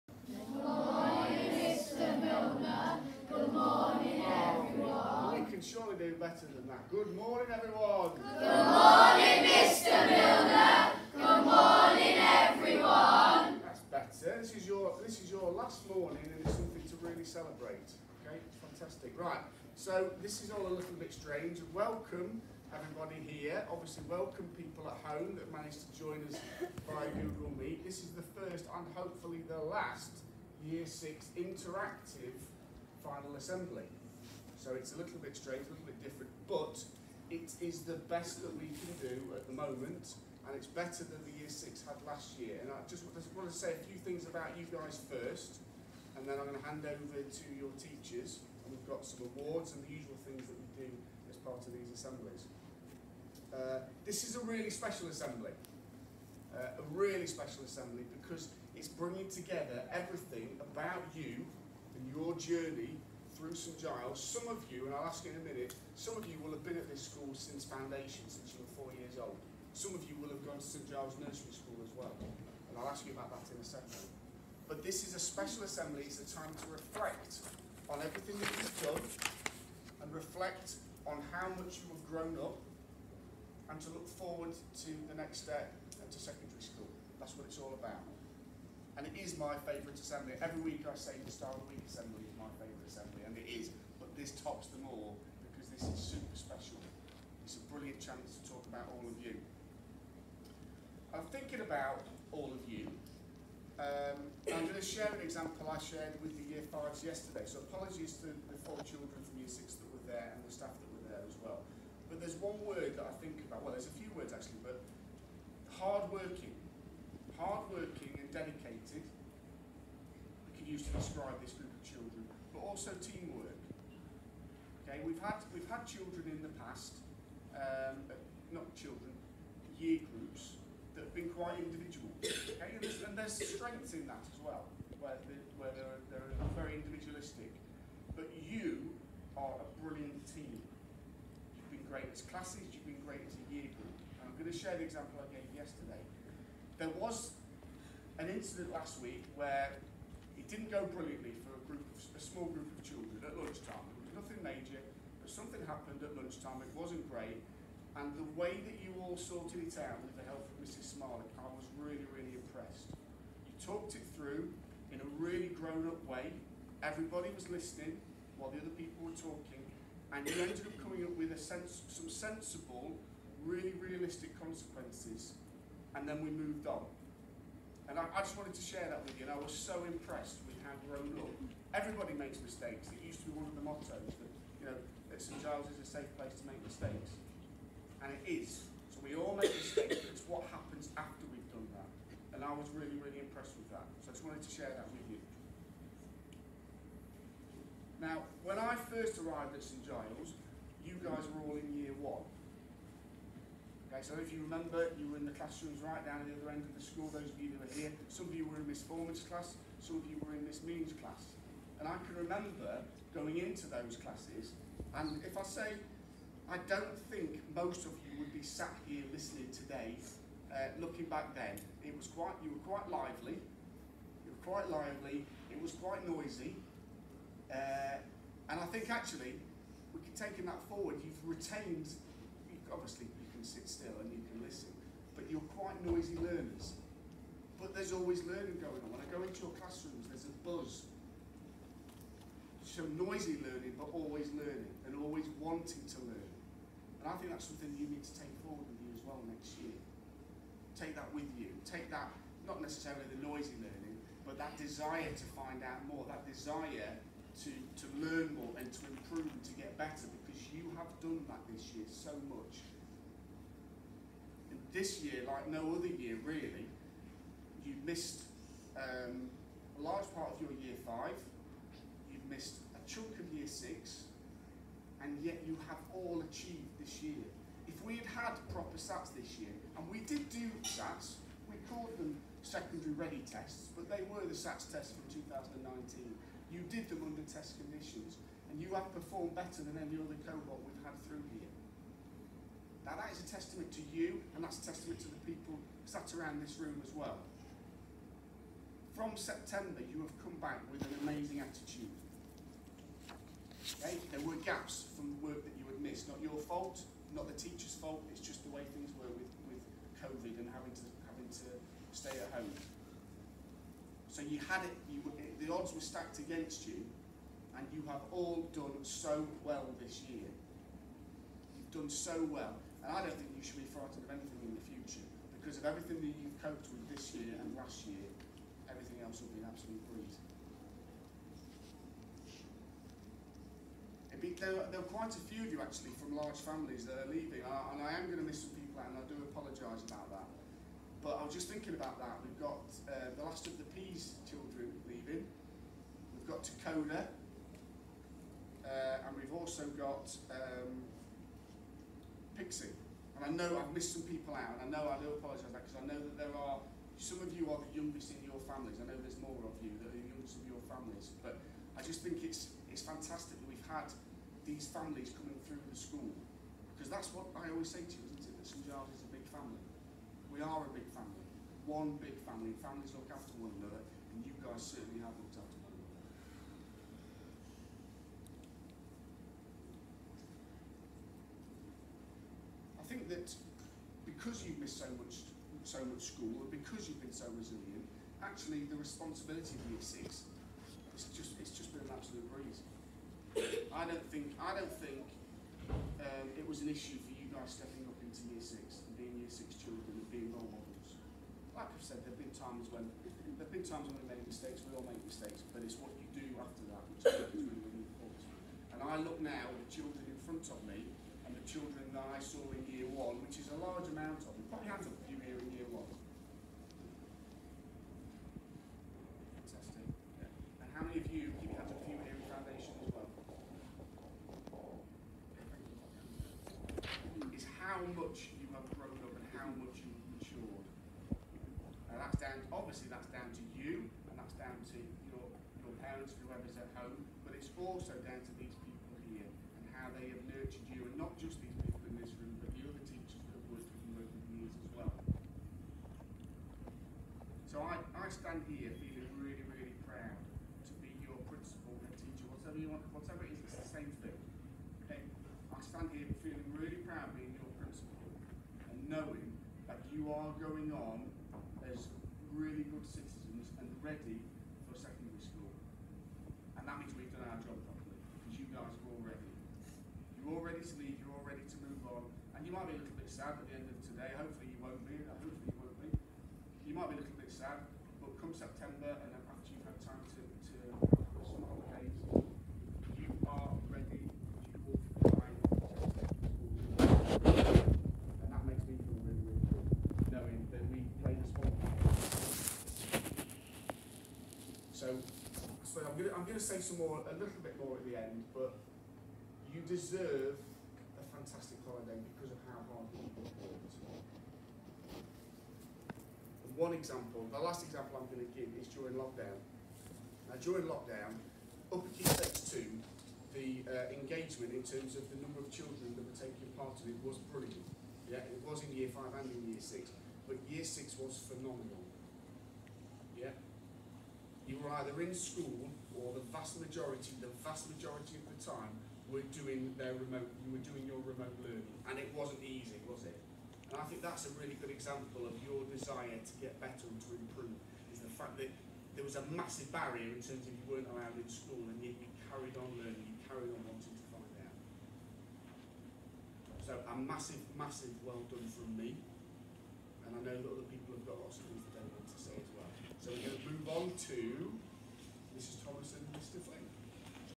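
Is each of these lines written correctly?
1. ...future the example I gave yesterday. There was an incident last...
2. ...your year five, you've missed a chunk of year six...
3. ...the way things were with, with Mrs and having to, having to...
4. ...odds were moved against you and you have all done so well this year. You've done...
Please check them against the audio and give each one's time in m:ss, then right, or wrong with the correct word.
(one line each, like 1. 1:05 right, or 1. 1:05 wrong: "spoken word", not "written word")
1. 2:24 wrong: "share", not "future"
2. 4:30 right
3. 5:08 wrong: "COVID", not "Mrs"
4. 5:15 wrong: "stacked", not "moved".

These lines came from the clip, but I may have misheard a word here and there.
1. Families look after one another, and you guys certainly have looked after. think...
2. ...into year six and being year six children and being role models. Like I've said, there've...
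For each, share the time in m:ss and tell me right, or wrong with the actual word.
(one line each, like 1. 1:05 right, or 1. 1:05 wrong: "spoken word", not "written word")
1. 6:12 right
2. 6:38 right.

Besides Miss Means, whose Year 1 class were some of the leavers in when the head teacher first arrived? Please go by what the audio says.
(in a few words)
Miss Foreman.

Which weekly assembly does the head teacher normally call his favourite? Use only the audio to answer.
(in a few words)
Star of the Week.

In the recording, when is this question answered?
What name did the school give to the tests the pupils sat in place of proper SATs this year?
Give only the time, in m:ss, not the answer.
4:42.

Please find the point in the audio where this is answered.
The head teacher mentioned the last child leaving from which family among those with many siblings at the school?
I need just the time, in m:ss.
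5:43.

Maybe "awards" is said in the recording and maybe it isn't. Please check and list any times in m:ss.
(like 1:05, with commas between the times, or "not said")
0:49.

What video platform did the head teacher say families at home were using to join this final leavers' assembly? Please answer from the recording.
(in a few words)
Google Meet.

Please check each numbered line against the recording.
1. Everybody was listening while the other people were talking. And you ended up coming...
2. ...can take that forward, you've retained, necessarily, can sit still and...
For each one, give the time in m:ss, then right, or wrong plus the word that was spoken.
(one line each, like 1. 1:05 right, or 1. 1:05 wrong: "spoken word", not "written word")
1. 2:46 right
2. 3:49 wrong: "obviously", not "necessarily".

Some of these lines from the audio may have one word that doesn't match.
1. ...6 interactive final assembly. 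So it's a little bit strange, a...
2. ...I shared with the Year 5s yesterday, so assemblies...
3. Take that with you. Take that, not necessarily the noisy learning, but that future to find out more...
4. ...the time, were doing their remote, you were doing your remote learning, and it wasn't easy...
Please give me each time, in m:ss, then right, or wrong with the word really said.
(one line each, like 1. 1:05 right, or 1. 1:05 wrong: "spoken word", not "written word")
1. 0:30 right
2. 1:45 wrong: "apologies", not "assemblies"
3. 4:10 wrong: "desire", not "future"
4. 8:48 right.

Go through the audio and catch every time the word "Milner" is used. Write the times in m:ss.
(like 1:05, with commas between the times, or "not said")
0:10.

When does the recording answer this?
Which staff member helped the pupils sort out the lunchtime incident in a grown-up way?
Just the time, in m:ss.
2:40.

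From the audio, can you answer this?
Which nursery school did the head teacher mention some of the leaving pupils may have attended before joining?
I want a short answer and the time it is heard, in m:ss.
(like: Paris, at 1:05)
St Giles Nursery School, at 1:10.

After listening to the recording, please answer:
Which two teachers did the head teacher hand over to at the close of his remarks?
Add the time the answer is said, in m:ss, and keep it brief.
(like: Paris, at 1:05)
Mrs. Thomas and Mr. Flint, at 9:15.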